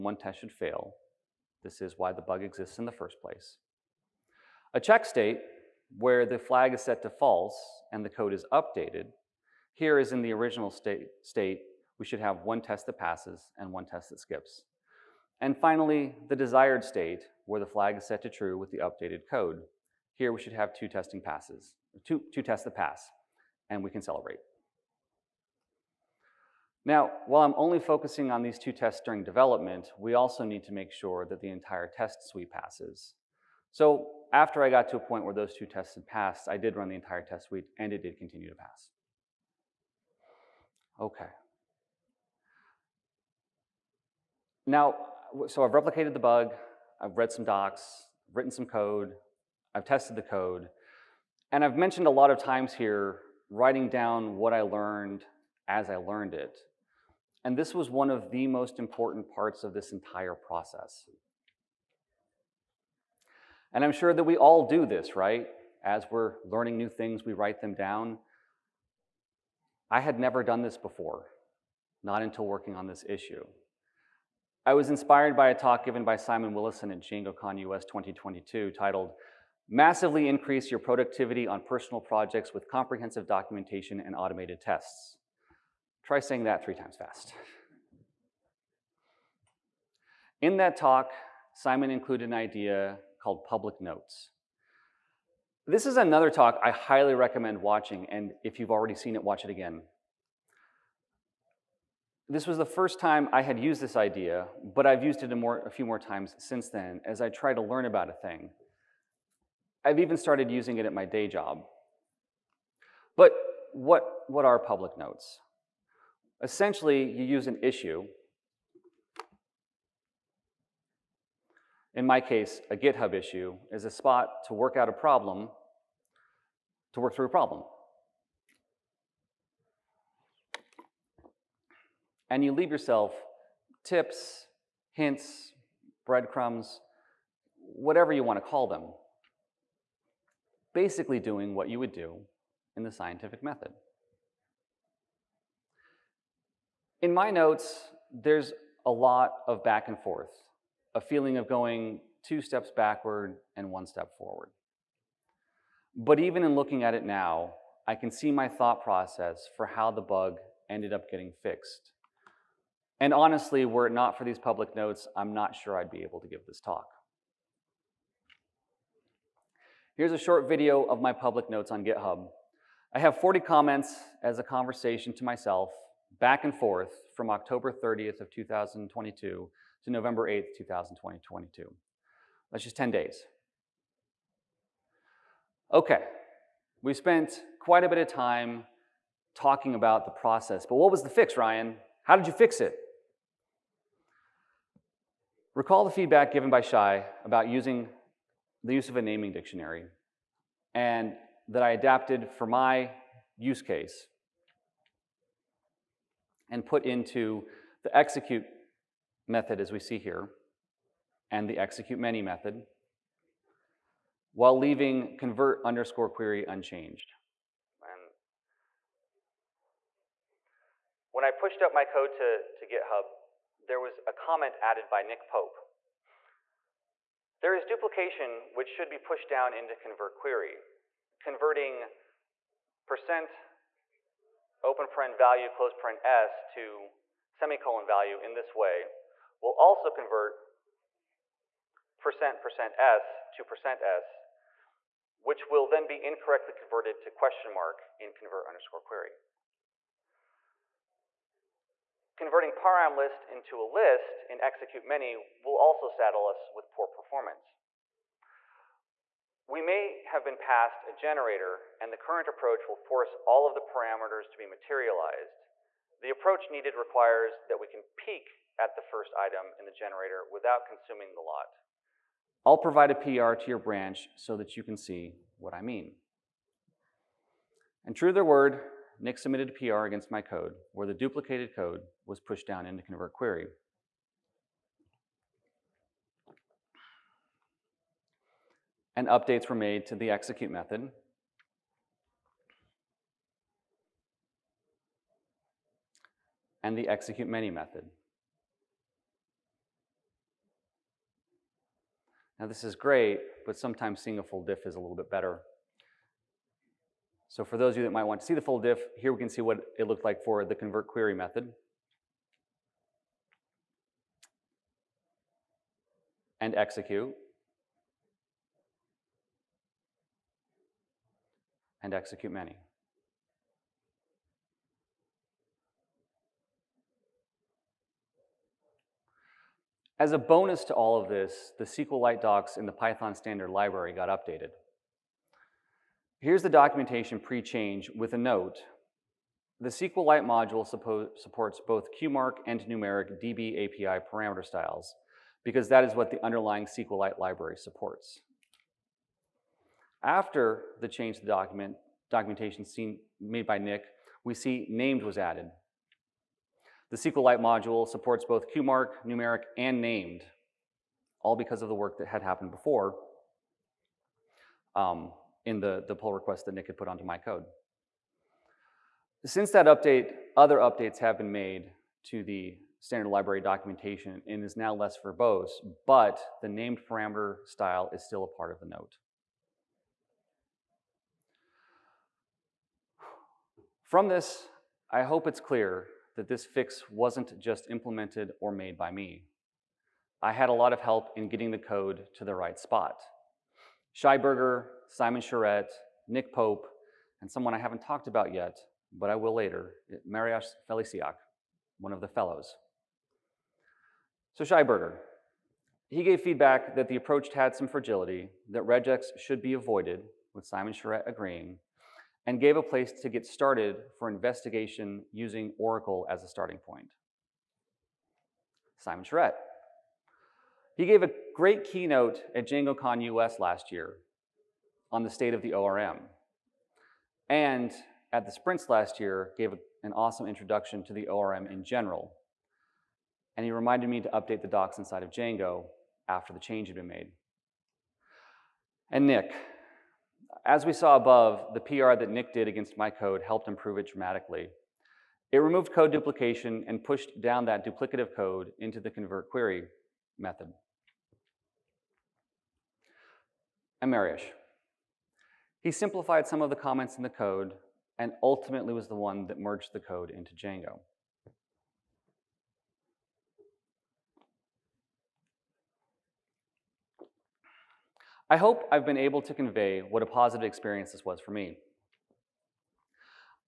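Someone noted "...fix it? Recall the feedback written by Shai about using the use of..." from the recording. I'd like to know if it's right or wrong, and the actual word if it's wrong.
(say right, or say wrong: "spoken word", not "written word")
wrong: "given", not "written".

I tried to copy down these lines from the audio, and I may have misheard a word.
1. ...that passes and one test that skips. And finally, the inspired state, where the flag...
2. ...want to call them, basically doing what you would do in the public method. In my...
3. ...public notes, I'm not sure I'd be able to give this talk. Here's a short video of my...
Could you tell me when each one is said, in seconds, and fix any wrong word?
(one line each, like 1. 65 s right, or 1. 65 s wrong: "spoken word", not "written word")
1. 12 s wrong: "desired", not "inspired"
2. 138 s wrong: "scientific", not "public"
3. 164 s right.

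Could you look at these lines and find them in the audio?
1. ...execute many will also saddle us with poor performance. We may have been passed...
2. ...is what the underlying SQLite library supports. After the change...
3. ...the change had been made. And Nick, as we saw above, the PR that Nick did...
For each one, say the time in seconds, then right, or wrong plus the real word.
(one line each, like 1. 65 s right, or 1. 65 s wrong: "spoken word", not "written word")
1. 254 s right
2. 345 s right
3. 436 s right.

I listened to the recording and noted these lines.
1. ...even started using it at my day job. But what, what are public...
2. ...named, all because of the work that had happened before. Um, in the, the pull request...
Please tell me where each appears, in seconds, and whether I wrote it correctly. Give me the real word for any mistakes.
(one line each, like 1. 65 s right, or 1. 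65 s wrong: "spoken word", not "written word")
1. 110 s right
2. 359 s right.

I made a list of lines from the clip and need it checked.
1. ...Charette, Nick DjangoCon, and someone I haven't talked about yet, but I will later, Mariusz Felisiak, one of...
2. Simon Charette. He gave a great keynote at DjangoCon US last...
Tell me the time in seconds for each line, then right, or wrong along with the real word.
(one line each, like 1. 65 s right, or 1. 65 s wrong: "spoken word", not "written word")
1. 395 s wrong: "Pope", not "DjangoCon"
2. 418 s right.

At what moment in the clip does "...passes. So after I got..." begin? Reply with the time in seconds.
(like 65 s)
32 s.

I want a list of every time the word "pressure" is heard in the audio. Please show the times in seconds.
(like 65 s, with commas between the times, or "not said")
not said.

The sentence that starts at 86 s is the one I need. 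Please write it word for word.
Try saying that three times fast.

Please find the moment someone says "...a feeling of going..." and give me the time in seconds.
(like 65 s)
150 s.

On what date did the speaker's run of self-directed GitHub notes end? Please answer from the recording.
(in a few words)
November 8th, 2022.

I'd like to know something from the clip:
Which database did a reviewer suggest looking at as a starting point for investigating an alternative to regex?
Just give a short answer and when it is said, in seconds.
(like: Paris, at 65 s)
Oracle, at 415 s.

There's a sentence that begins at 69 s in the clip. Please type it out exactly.
I had never done this before, not until working on this issue.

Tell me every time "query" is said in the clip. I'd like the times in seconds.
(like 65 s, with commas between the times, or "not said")
216 s, 230 s, 248 s, 283 s, 310 s, 449 s.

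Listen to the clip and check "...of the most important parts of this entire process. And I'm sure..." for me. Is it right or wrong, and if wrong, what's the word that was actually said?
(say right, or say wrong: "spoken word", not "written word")
right.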